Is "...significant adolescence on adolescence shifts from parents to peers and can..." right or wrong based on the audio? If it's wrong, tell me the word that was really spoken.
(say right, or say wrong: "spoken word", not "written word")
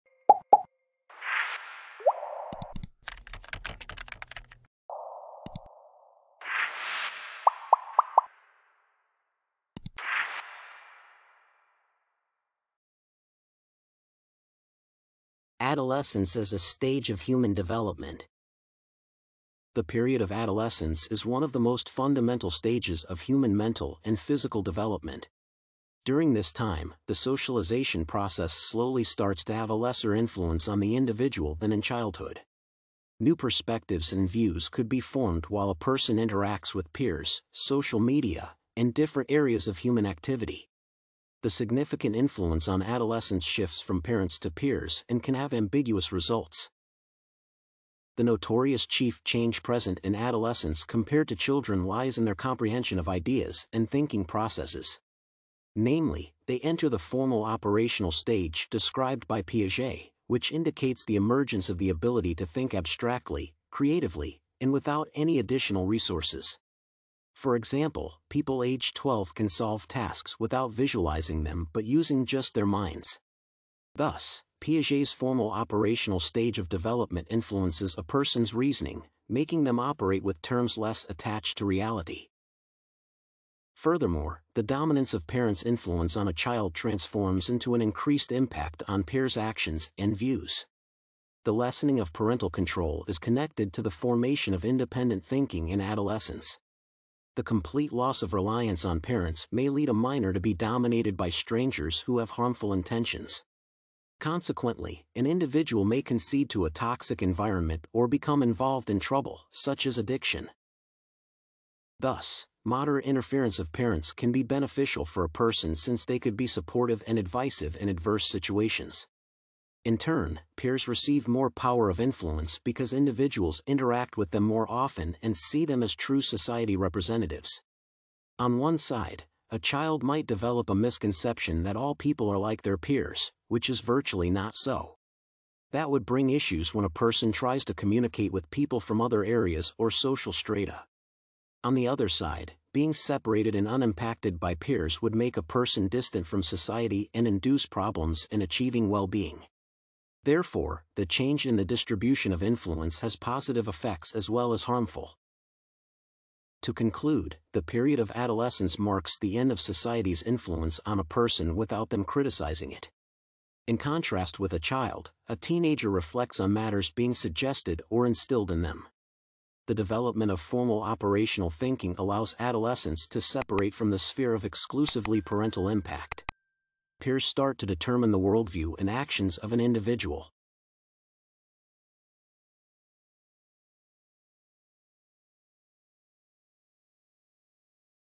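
wrong: "influence", not "adolescence".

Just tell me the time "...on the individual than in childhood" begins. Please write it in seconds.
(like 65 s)
30 s.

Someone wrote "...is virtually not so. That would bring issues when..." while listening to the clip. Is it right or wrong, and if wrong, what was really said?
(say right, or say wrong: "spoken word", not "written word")
right.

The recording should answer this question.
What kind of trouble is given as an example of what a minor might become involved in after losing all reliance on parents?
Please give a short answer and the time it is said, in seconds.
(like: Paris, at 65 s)
Addiction, at 109 s.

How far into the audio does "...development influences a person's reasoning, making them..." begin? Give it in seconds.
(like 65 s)
76 s.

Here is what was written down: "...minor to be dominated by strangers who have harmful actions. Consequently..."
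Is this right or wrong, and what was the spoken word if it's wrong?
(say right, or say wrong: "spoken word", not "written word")
wrong: "intentions", not "actions".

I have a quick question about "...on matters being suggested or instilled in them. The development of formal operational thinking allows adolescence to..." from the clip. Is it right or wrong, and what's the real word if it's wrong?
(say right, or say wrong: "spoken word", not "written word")
right.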